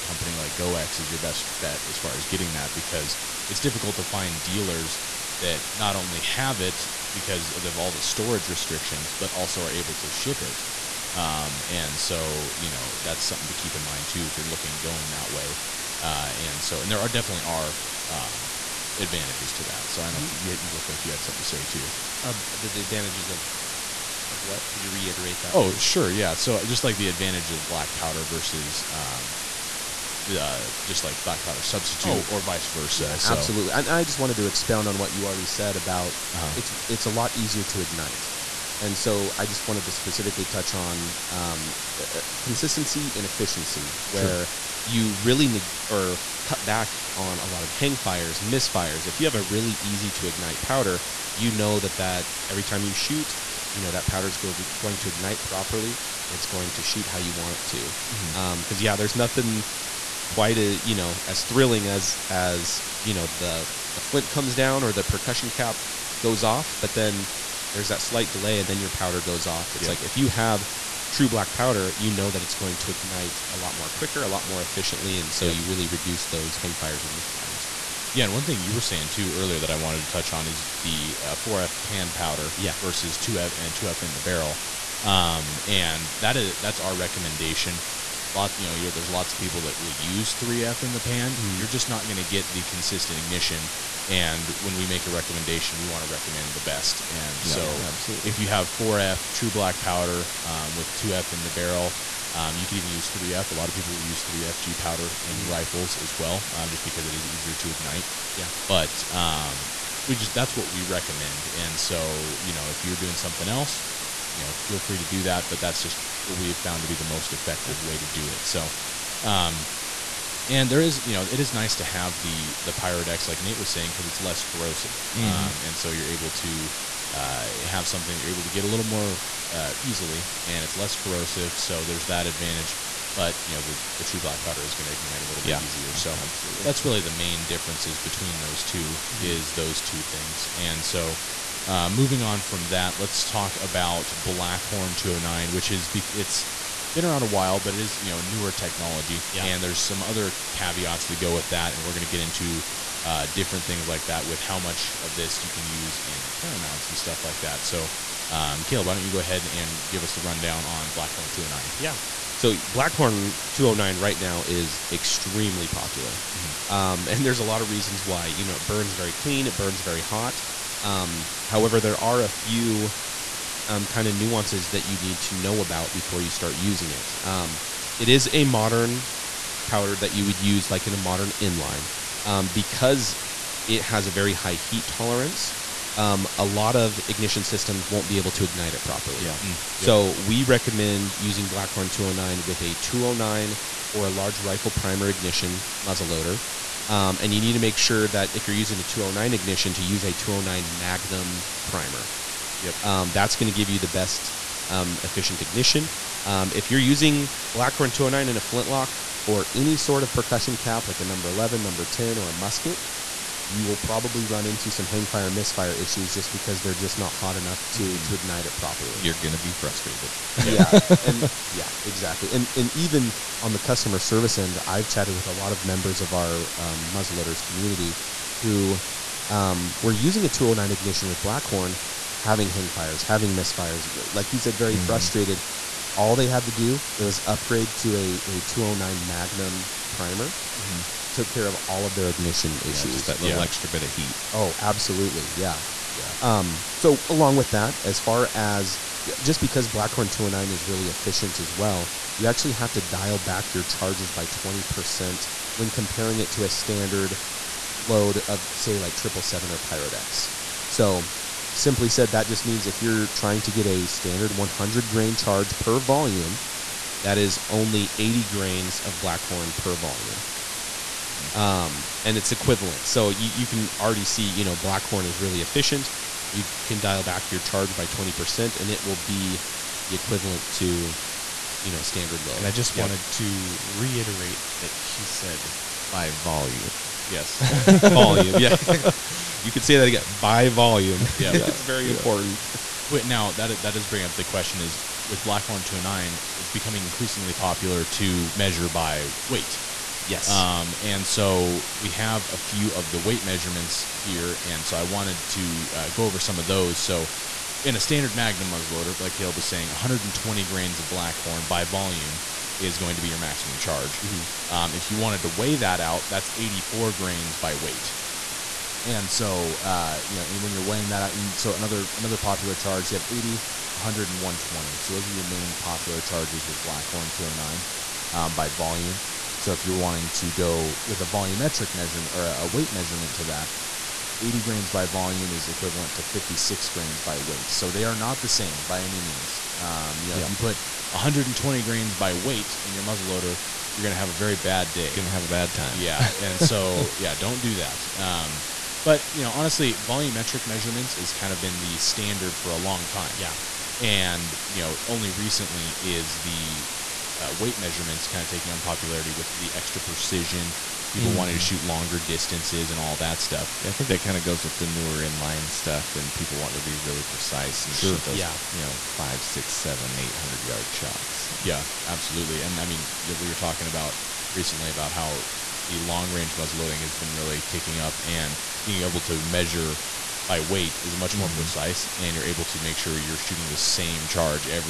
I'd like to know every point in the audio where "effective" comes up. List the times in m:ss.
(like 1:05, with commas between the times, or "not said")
1:57.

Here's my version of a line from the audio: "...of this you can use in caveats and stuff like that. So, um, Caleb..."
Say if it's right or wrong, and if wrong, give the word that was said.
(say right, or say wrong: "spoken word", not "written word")
wrong: "paramounts", not "caveats".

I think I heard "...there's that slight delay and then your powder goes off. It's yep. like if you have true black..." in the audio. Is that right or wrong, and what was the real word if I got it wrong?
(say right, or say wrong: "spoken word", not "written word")
right.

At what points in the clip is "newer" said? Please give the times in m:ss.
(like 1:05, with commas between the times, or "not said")
2:28, 6:04.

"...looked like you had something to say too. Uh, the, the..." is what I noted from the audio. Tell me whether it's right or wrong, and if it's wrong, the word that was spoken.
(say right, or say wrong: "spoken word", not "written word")
right.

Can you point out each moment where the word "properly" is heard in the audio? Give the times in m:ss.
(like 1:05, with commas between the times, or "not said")
0:55, 3:08, 3:38.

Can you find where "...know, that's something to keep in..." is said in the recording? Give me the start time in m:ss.
0:12.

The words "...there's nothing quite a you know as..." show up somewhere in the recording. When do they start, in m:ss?
0:58.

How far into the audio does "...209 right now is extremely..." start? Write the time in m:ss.
2:43.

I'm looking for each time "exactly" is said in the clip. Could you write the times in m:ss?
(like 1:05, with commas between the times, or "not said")
3:41.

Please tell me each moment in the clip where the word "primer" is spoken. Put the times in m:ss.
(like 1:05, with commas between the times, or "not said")
3:14, 3:21, 3:59.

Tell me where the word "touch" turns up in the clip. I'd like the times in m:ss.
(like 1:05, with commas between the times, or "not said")
0:40, 1:20.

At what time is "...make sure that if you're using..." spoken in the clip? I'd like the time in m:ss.
3:17.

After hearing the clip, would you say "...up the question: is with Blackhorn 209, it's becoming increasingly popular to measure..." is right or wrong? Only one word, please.
right.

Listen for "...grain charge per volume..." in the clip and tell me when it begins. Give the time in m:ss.
4:24.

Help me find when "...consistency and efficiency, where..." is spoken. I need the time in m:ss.
0:42.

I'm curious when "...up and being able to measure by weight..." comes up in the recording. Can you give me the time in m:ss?
6:17.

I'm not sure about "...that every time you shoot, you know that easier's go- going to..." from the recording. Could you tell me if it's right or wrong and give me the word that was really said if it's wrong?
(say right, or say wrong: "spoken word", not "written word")
wrong: "powder", not "easier".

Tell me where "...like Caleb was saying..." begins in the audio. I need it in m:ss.
5:08.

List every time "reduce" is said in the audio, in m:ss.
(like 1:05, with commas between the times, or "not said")
1:15.